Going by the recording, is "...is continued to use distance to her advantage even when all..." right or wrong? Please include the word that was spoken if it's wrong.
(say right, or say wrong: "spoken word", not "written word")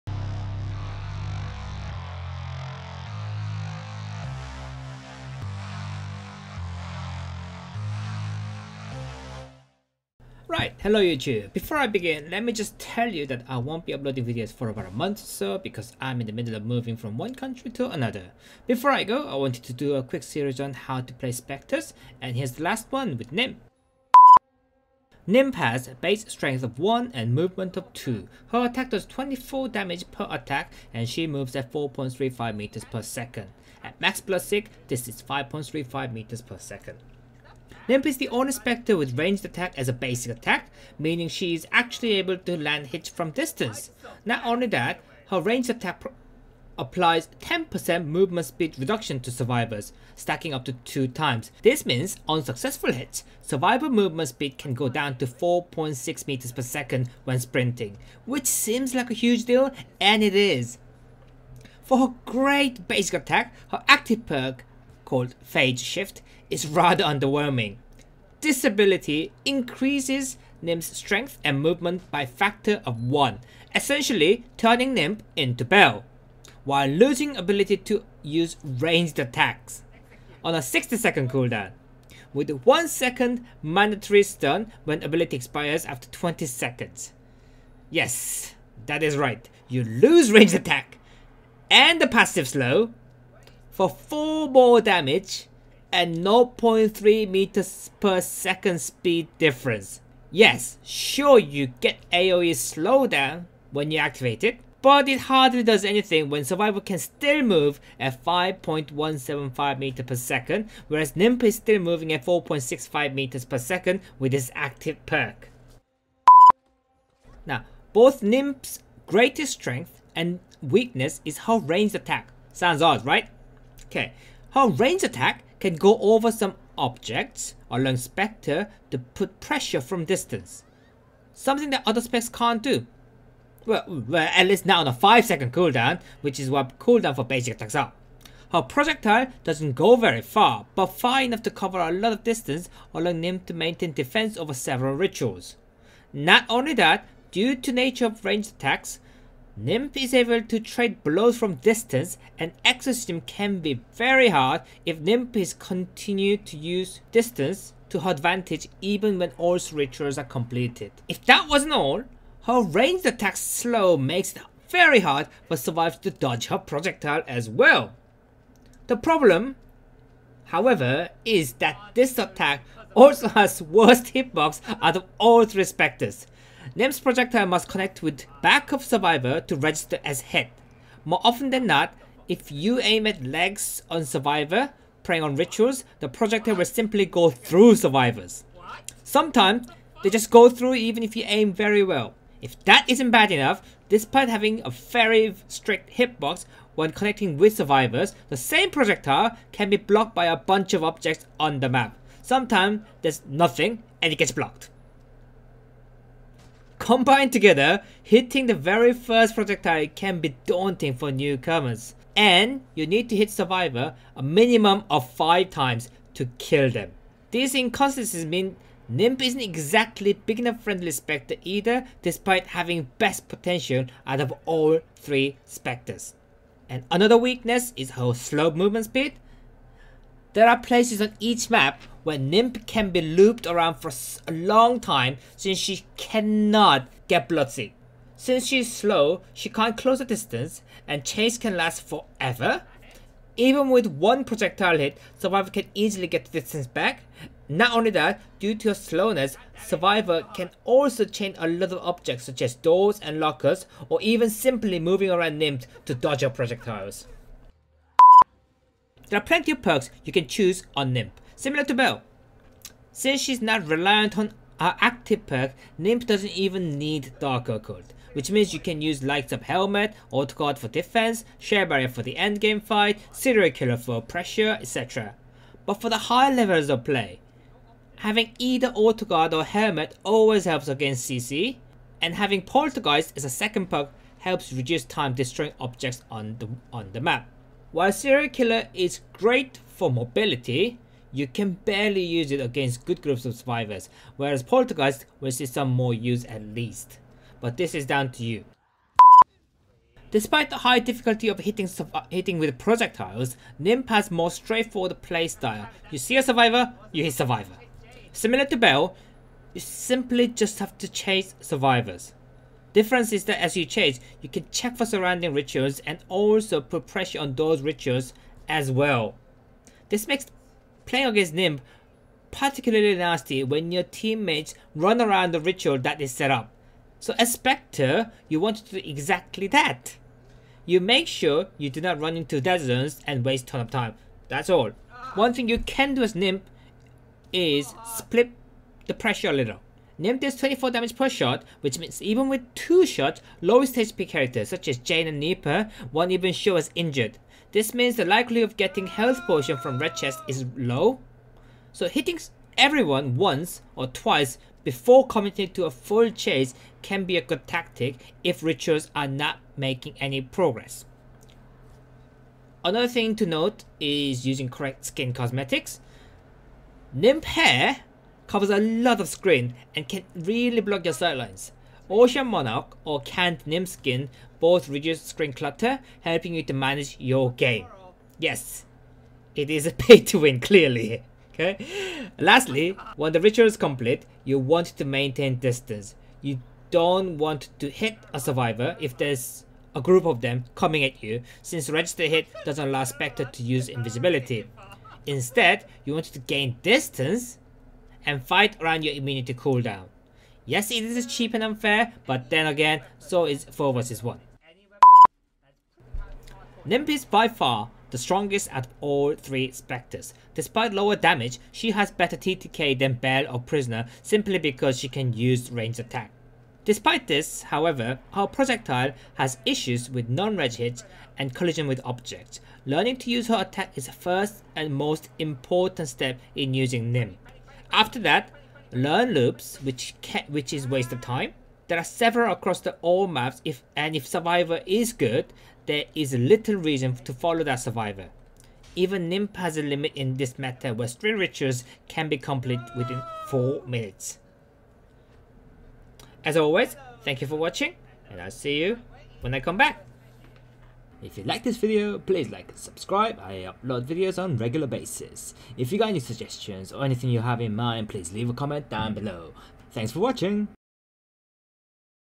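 right.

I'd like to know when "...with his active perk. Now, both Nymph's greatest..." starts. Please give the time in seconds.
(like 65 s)
114 s.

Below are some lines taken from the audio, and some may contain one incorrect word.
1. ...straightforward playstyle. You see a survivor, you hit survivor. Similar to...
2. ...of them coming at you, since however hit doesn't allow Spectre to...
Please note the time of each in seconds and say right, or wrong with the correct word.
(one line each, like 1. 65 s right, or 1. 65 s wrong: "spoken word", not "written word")
1. 304 s right
2. 390 s wrong: "register", not "however".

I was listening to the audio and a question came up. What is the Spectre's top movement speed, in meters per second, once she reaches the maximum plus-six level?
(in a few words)
5.35.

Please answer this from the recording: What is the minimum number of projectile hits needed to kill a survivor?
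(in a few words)
5.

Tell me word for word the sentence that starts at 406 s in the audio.
Nymph is by far the strongest out of all three Spectres.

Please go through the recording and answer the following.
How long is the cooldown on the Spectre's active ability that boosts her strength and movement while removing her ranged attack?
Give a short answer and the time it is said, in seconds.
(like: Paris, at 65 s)
60 seconds, at 80 s.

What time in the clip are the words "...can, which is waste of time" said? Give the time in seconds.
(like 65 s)
430 s.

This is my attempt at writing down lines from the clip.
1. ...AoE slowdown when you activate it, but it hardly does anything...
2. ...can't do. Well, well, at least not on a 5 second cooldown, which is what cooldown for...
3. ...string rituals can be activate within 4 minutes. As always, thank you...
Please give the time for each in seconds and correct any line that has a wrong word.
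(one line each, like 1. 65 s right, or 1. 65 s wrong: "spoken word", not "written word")
1. 102 s right
2. 132 s right
3. 440 s wrong: "complete", not "activate".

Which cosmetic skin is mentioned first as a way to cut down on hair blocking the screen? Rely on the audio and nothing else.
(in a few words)
Ocean Monarch.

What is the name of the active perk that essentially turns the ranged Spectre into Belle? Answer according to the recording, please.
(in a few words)
phase shift.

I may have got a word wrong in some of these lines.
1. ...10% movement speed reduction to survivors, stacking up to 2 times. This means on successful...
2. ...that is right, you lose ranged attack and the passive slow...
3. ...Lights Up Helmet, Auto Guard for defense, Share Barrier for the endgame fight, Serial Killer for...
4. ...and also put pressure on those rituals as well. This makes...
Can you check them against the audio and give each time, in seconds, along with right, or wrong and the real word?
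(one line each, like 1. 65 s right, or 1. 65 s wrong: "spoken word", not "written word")
1. 47 s right
2. 88 s right
3. 269 s right
4. 315 s right.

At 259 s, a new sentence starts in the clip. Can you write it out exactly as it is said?
There are plenty of perks you can choose on Nymph.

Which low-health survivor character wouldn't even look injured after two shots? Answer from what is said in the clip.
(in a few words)
Jane.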